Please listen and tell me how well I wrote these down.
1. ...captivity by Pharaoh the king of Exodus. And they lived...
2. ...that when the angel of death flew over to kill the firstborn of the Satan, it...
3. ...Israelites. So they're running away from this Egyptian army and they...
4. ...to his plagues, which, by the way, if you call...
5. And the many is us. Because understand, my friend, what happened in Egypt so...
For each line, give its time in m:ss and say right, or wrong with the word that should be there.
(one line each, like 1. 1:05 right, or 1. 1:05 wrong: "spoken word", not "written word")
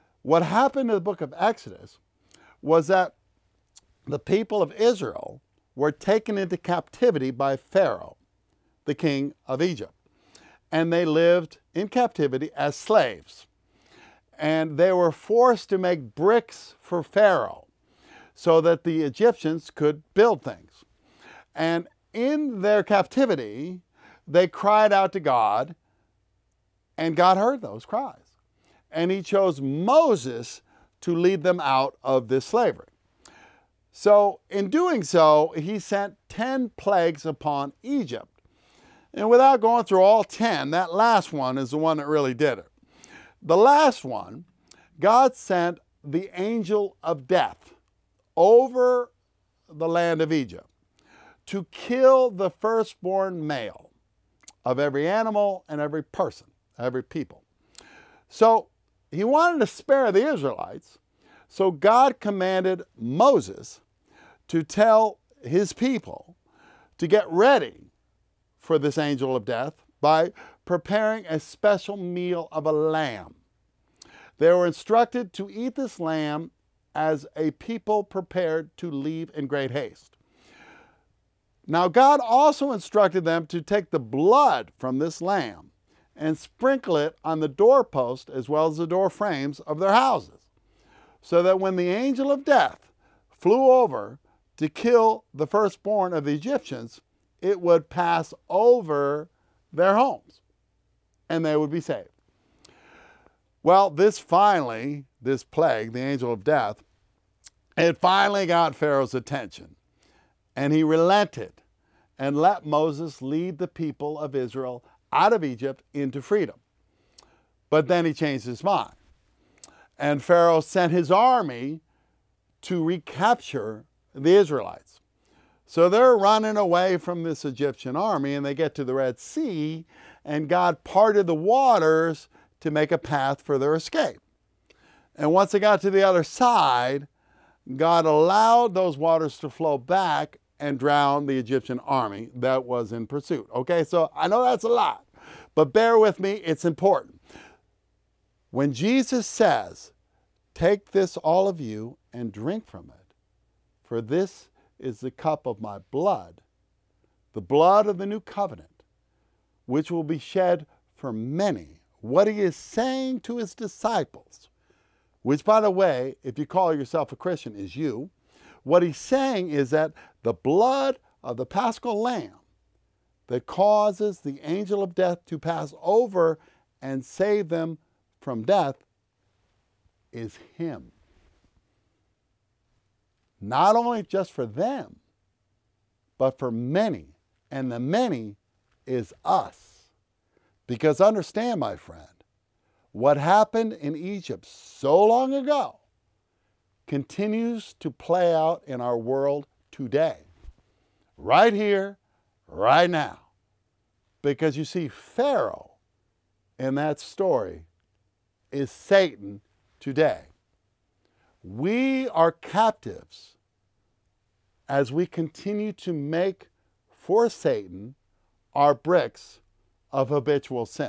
1. 0:06 wrong: "Egypt", not "Exodus"
2. 1:31 wrong: "Egyptians", not "Satan"
3. 2:04 right
4. 2:43 wrong: "disciples", not "plagues"
5. 3:07 right.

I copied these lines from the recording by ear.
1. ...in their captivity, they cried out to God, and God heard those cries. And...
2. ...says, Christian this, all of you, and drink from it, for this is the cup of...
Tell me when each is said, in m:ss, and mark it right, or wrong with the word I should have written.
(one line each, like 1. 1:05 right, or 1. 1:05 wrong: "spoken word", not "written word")
1. 0:22 right
2. 2:29 wrong: "Take", not "Christian".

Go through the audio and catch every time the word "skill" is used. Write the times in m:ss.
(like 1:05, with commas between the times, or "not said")
not said.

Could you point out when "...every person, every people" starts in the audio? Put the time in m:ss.
0:55.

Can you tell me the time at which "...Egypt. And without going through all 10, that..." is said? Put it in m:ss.
0:37.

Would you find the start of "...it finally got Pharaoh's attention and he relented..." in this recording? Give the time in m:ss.
1:47.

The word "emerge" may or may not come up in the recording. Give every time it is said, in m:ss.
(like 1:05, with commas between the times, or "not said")
not said.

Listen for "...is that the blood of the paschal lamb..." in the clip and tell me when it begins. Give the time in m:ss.
2:49.